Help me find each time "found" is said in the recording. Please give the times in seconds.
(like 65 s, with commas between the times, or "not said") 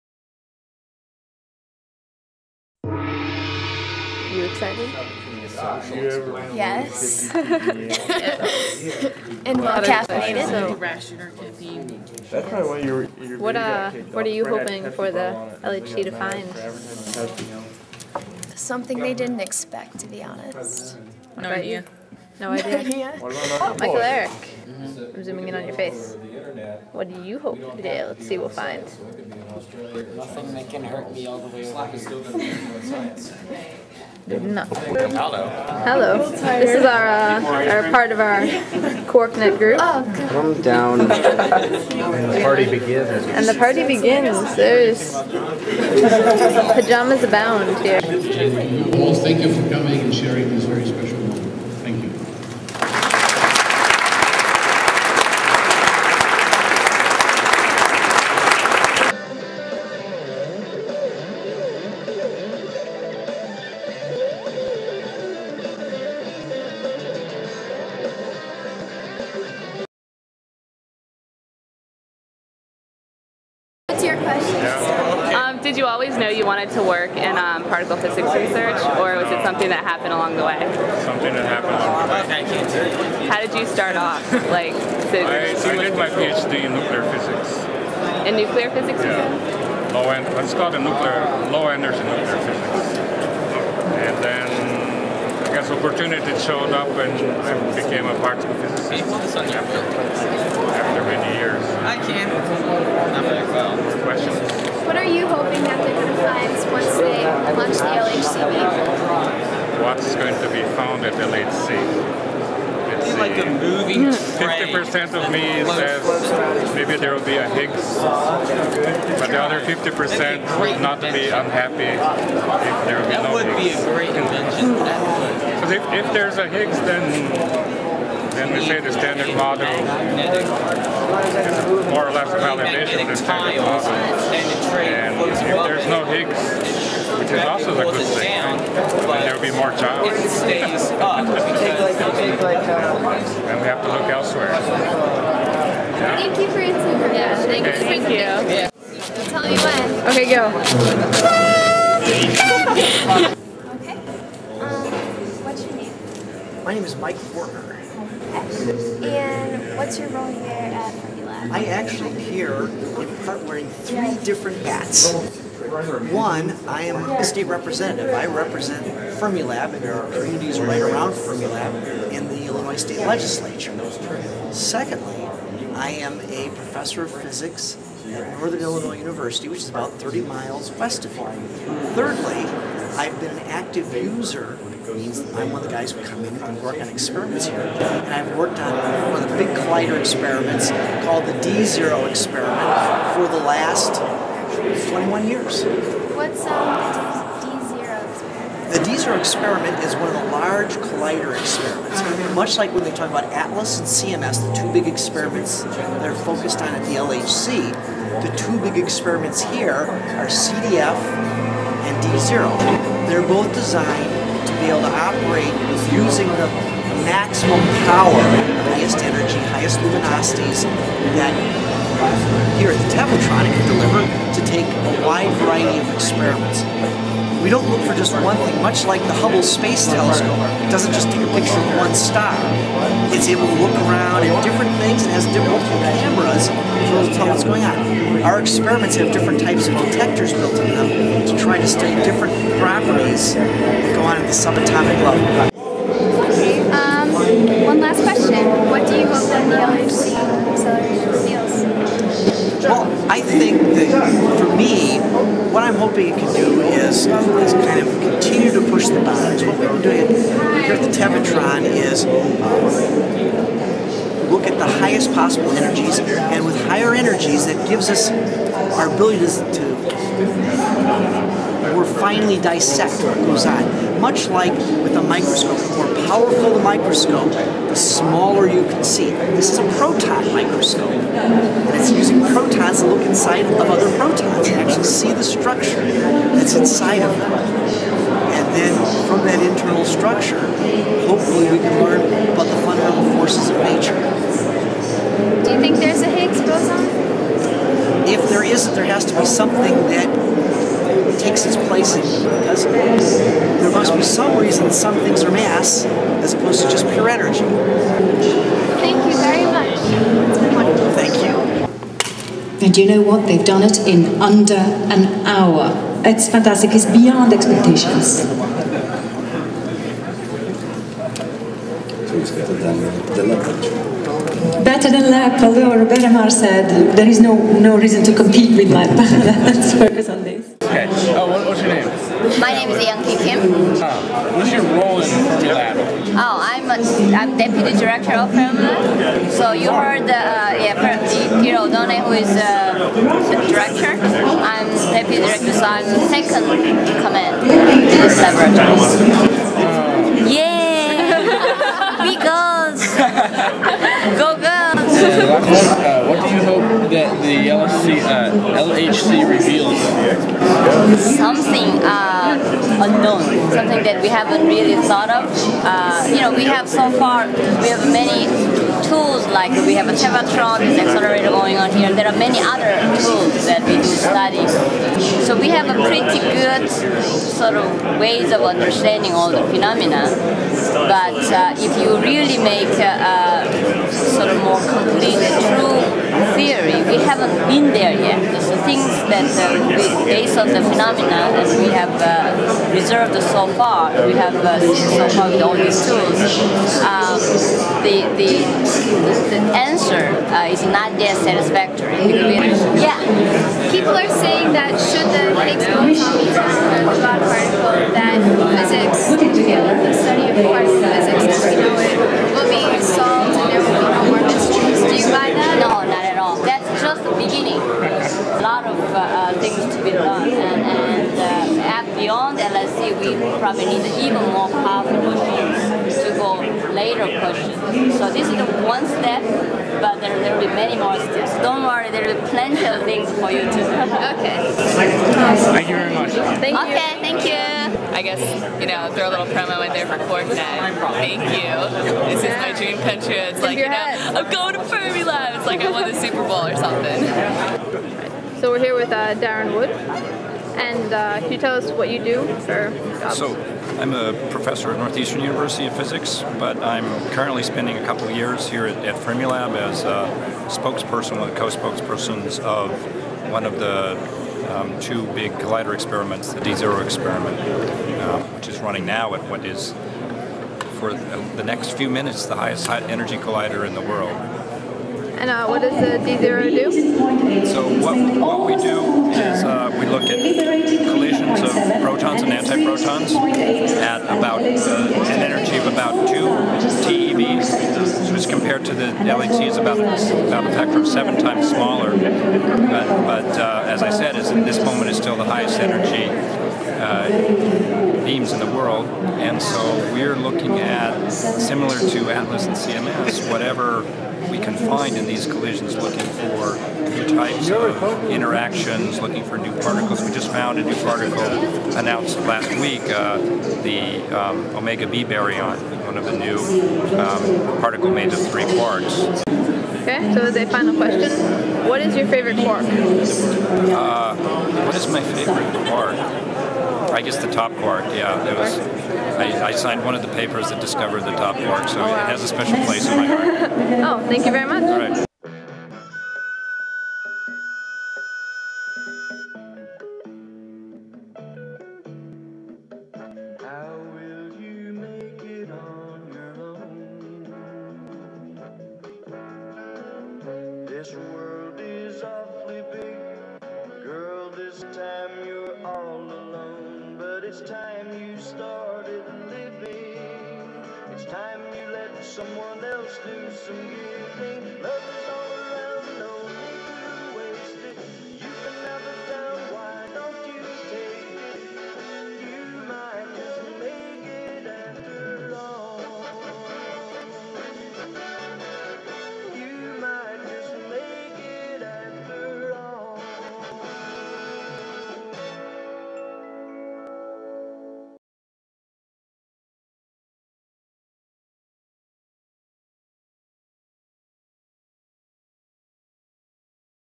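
110 s, 510 s.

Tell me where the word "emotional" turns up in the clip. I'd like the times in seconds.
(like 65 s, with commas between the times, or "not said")
not said.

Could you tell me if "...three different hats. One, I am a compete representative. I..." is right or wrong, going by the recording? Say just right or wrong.
wrong.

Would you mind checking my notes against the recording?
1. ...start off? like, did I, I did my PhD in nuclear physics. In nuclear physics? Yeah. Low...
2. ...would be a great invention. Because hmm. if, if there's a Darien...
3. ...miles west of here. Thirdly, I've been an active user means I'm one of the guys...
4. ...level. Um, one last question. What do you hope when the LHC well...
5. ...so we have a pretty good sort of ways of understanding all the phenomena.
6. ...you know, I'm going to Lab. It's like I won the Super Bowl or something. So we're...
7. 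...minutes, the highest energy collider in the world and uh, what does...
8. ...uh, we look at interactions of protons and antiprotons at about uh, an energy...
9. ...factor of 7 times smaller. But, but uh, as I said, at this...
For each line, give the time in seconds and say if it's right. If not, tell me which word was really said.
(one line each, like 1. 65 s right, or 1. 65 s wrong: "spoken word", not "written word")
1. 83 s right
2. 123 s wrong: "Higgs", not "Darien"
3. 180 s right
4. 245 s right
5. 374 s right
6. 443 s right
7. 471 s right
8. 479 s wrong: "collisions", not "interactions"
9. 490 s right.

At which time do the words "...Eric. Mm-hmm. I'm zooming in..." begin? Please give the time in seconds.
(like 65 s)
23 s.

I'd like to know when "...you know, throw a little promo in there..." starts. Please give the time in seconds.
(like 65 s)
438 s.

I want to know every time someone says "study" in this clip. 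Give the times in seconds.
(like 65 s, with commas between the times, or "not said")
241 s, 409 s.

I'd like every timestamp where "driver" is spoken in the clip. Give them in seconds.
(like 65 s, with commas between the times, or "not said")
not said.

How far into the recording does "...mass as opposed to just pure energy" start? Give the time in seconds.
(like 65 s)
305 s.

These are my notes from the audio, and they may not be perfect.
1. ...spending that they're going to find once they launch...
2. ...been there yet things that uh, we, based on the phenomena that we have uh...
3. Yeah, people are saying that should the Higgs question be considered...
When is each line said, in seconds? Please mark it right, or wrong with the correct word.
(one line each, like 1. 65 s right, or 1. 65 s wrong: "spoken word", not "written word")
1. 105 s wrong: "hoping", not "spending"
2. 387 s right
3. 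402 s wrong: "boson", not "question".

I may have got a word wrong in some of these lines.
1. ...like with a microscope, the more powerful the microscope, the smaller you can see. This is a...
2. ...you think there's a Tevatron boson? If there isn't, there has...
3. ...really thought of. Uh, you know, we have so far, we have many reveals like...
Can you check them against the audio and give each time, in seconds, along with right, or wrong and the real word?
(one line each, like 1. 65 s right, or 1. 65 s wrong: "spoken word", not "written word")
1. 274 s right
2. 295 s wrong: "Higgs", not "Tevatron"
3. 364 s wrong: "tools", not "reveals".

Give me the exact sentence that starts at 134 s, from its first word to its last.
And if there's no Higgs, is also a good thing.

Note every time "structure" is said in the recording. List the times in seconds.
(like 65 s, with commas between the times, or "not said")
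285 s, 289 s.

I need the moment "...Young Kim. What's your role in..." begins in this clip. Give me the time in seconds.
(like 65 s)
332 s.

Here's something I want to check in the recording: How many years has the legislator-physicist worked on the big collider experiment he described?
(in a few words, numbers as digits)
21.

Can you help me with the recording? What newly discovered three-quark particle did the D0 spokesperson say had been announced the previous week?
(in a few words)
Omega B baryon.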